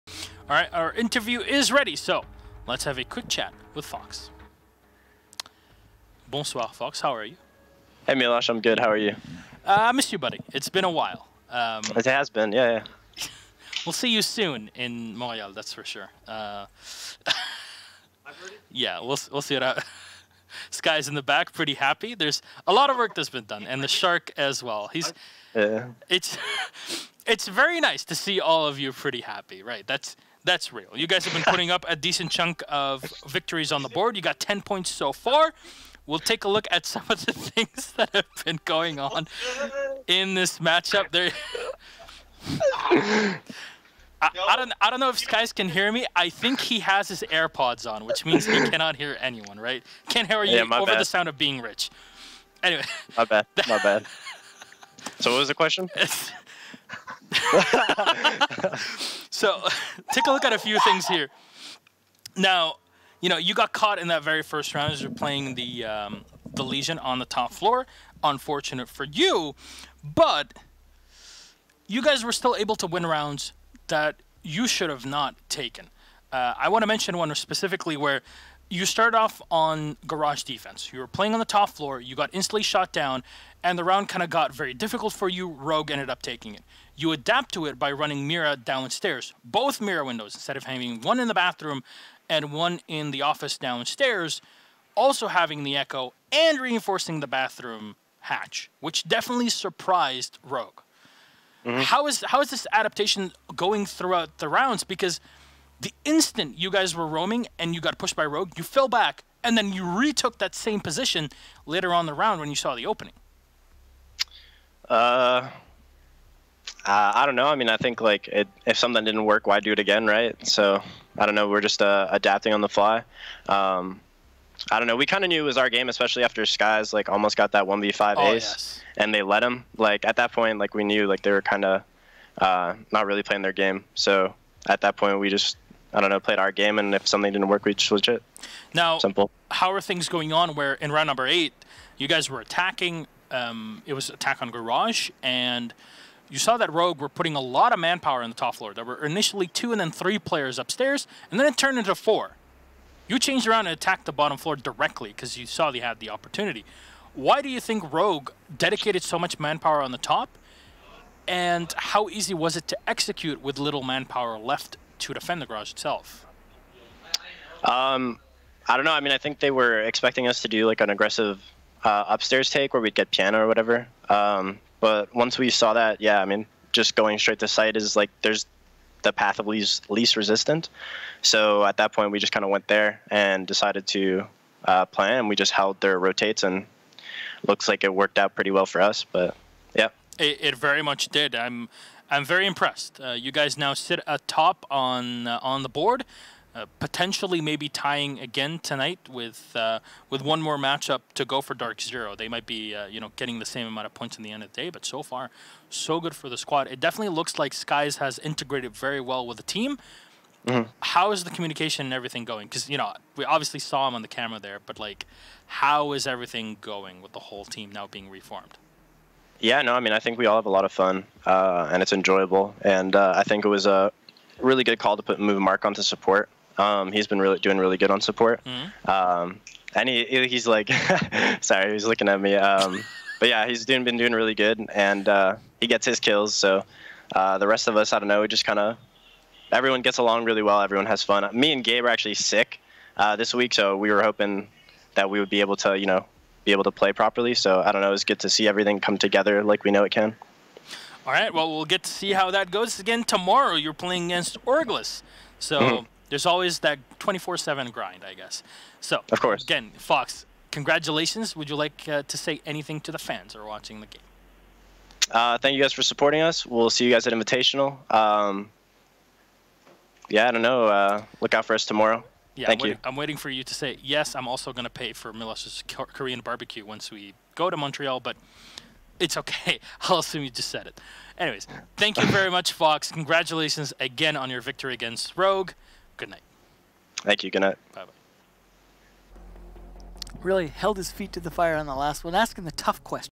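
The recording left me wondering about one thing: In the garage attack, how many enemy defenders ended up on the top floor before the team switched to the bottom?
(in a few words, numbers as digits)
4.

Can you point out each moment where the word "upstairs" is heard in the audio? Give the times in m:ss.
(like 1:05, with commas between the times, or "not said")
2:30, 2:52.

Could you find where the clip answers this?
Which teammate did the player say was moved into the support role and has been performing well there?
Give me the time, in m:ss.
3:45.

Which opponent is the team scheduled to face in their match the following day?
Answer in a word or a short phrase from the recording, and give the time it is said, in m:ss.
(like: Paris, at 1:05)
Orglis, at 4:14.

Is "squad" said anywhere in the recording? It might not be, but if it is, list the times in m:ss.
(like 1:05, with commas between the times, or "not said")
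3:26.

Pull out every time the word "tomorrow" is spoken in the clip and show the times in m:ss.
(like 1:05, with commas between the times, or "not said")
4:13, 4:31.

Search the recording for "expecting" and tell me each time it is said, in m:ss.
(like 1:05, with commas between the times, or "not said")
2:49.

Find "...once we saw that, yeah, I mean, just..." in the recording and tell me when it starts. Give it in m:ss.
2:55.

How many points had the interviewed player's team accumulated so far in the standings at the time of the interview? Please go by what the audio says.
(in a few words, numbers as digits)
10.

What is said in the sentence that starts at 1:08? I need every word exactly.
Unfortunate for you, but you guys were still able to win rounds that you should have not taken.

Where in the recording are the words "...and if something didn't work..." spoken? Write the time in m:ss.
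2:16.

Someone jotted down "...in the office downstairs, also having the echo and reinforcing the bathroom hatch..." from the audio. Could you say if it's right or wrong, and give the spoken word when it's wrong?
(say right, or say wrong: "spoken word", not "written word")
right.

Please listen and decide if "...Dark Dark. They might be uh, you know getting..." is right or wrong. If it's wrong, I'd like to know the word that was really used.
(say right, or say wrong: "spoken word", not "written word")
wrong: "Zero", not "Dark".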